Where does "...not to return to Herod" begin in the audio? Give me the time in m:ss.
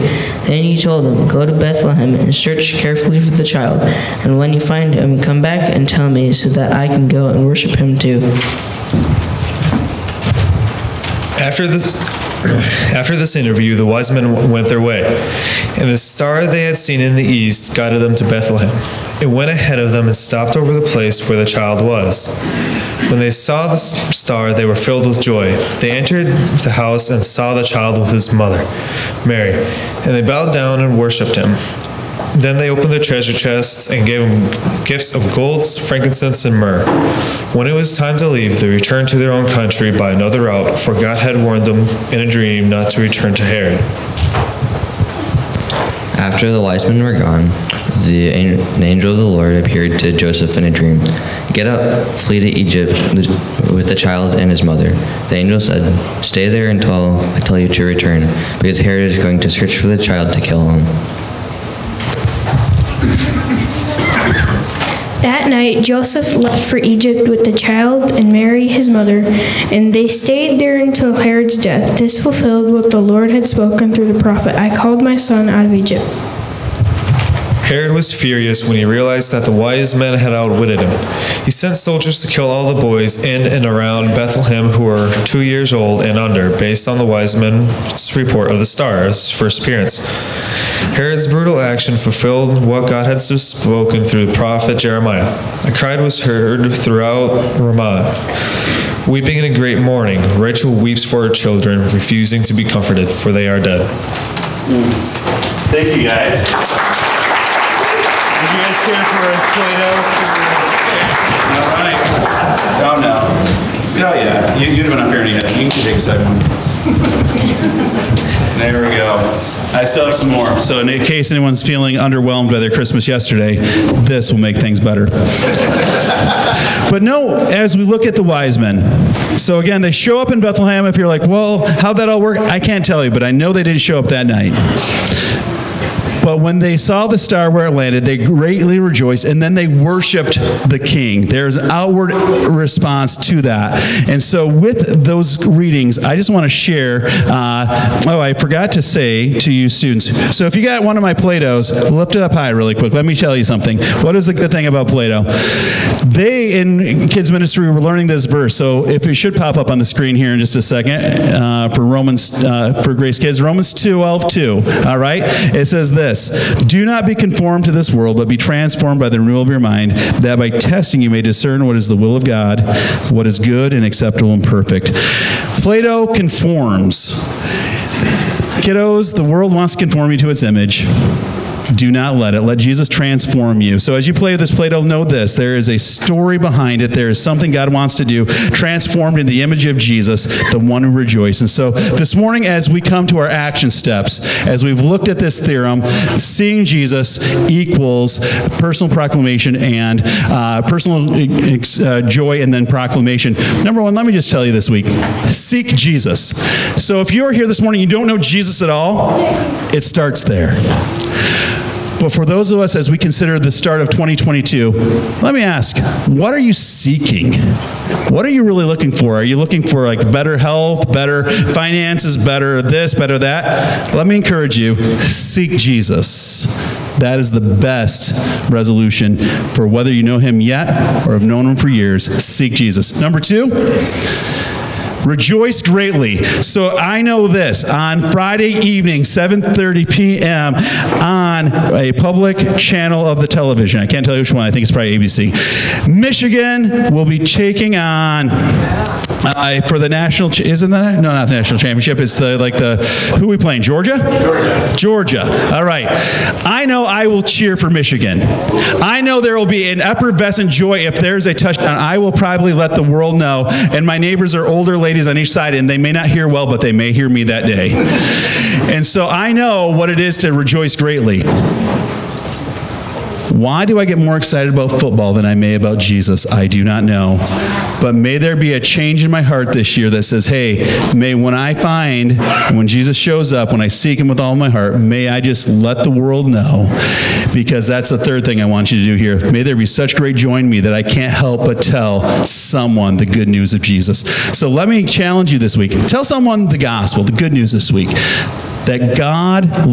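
0:42.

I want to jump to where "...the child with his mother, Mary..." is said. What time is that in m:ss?
0:27.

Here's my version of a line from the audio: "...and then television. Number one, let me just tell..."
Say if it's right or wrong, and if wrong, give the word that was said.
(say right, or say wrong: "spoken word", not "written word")
wrong: "proclamation", not "television".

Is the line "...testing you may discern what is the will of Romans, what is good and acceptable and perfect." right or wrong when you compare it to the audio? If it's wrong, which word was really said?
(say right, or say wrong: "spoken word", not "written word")
wrong: "God", not "Romans".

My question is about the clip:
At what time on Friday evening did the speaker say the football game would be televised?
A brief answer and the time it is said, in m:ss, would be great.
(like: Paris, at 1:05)
7:30 p.m., at 3:59.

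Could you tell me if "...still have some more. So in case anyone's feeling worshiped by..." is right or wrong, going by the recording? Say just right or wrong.
wrong.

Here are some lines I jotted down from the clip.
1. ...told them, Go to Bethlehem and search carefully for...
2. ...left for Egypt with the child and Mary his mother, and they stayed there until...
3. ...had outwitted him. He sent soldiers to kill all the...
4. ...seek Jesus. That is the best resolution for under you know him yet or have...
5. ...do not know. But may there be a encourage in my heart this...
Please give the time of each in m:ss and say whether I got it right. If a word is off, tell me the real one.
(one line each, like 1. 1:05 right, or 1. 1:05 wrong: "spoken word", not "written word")
1. 0:00 right
2. 1:06 right
3. 1:20 right
4. 3:45 wrong: "whether", not "under"
5. 4:36 wrong: "change", not "encourage".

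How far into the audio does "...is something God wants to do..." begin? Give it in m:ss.
3:07.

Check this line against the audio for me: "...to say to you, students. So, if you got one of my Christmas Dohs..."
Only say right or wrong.
wrong.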